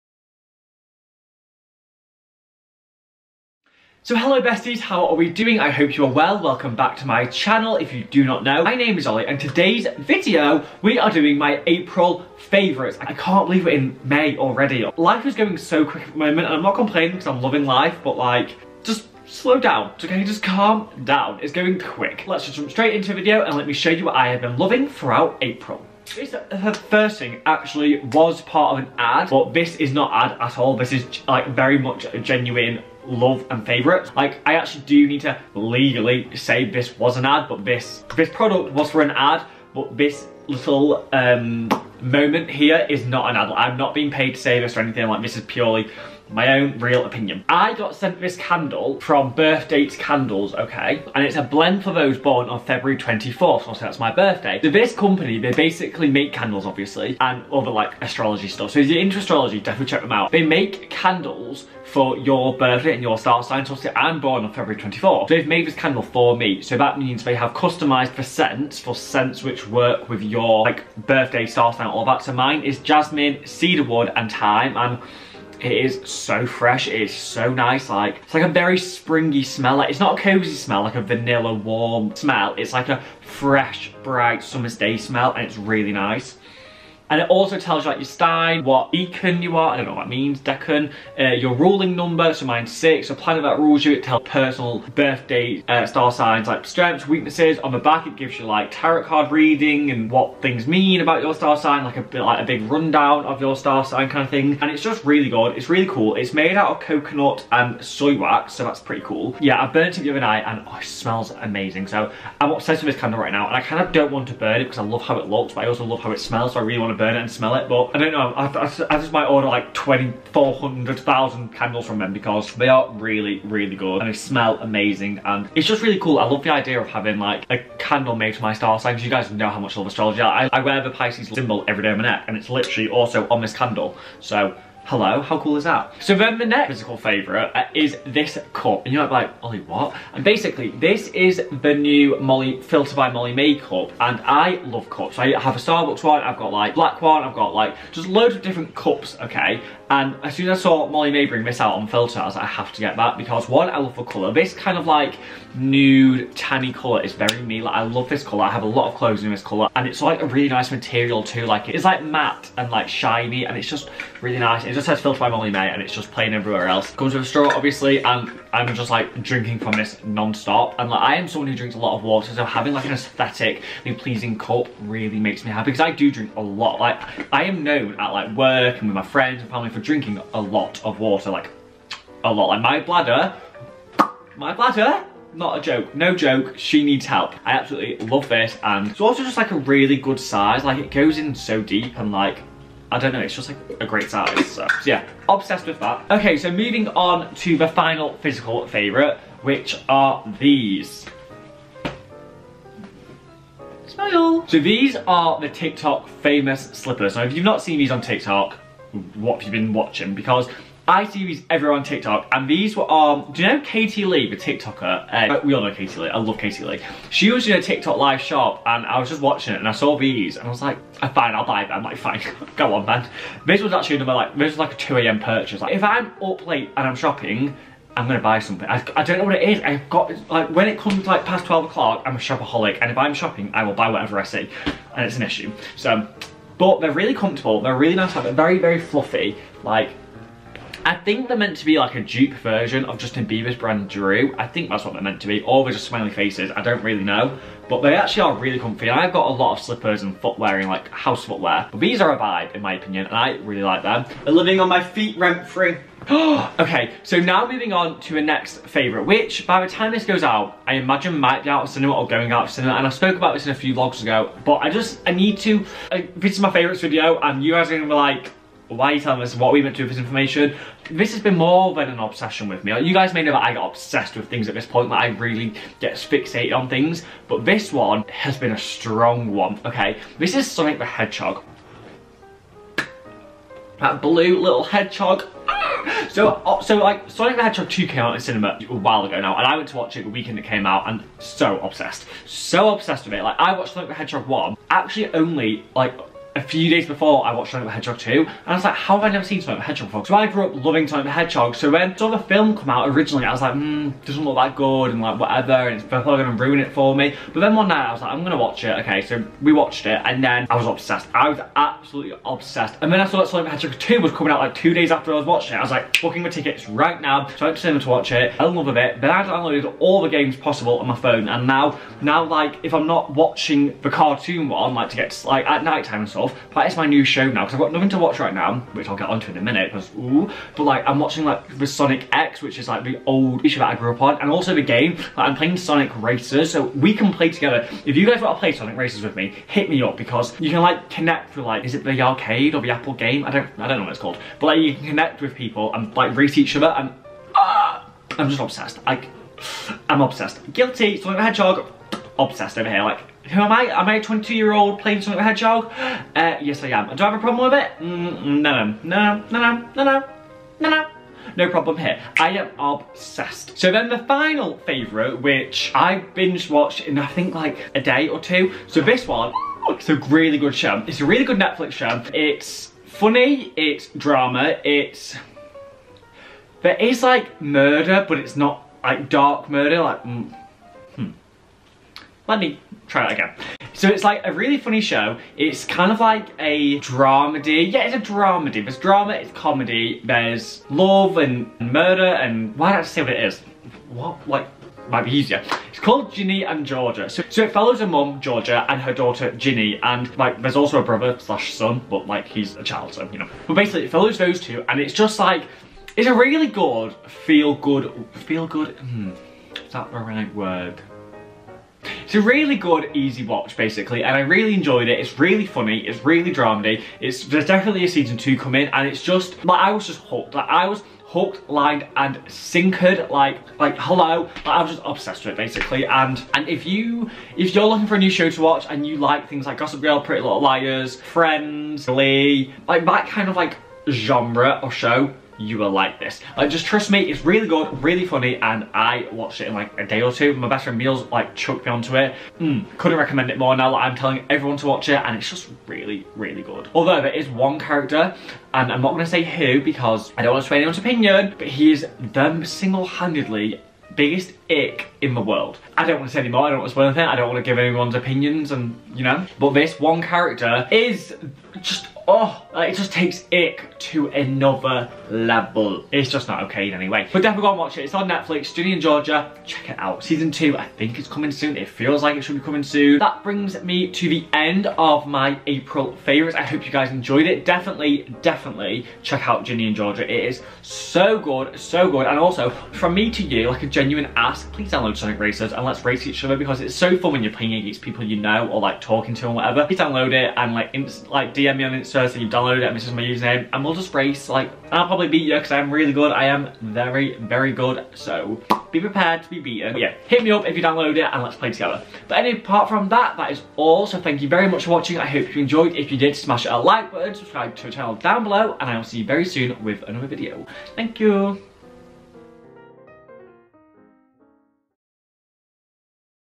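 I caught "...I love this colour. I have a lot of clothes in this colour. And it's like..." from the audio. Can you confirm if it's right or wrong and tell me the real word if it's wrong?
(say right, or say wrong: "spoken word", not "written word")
right.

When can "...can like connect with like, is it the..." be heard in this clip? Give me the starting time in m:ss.
5:40.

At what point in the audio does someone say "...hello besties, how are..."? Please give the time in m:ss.
0:04.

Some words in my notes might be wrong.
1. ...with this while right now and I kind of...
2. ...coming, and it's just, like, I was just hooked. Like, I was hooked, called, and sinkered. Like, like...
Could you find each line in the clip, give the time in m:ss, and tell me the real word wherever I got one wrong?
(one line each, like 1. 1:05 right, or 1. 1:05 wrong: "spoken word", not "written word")
1. 1:52 wrong: "candle", not "while"
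2. 6:58 wrong: "lined", not "called".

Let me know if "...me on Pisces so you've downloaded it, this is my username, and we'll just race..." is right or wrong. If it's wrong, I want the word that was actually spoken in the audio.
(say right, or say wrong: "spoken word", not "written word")
wrong: "Instagram", not "Pisces".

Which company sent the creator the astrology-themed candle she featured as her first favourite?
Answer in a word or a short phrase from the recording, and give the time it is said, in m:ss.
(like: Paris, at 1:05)
Birth Dates Candles, at 0:49.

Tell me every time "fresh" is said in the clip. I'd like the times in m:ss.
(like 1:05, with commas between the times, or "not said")
1:16, 1:23.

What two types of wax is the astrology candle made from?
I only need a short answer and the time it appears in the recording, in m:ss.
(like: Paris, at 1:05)
Coconut and soy, at 1:46.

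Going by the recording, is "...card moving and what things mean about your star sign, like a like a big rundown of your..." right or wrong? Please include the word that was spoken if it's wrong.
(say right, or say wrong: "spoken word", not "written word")
wrong: "reading", not "moving".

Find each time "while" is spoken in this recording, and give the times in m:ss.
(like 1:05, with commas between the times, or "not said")
4:48.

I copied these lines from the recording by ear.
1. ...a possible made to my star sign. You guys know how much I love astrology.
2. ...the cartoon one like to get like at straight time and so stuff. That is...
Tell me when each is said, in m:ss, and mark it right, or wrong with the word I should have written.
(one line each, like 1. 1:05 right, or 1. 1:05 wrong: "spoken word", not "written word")
1. 2:07 wrong: "candle", not "possible"
2. 5:23 wrong: "night", not "straight".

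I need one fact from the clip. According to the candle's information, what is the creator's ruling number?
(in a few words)
6.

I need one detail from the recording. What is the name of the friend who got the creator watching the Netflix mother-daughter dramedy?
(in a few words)
Meals.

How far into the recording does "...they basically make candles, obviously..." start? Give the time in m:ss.
0:55.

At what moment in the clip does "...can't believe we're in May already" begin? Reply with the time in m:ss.
0:13.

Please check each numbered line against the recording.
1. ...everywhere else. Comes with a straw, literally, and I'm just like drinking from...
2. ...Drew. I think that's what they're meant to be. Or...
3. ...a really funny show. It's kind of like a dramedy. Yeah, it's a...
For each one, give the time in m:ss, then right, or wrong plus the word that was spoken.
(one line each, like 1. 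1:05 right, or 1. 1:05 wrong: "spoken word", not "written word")
1. 2:46 wrong: "obviously", not "literally"
2. 4:03 right
3. 6:24 right.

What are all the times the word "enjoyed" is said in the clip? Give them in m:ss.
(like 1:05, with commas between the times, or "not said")
6:54, 7:56, 8:25.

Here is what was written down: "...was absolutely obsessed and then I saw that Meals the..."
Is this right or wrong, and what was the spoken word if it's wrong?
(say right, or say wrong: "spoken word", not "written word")
wrong: "Sonic", not "Meals".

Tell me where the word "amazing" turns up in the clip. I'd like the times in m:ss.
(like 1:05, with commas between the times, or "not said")
1:51, 2:04.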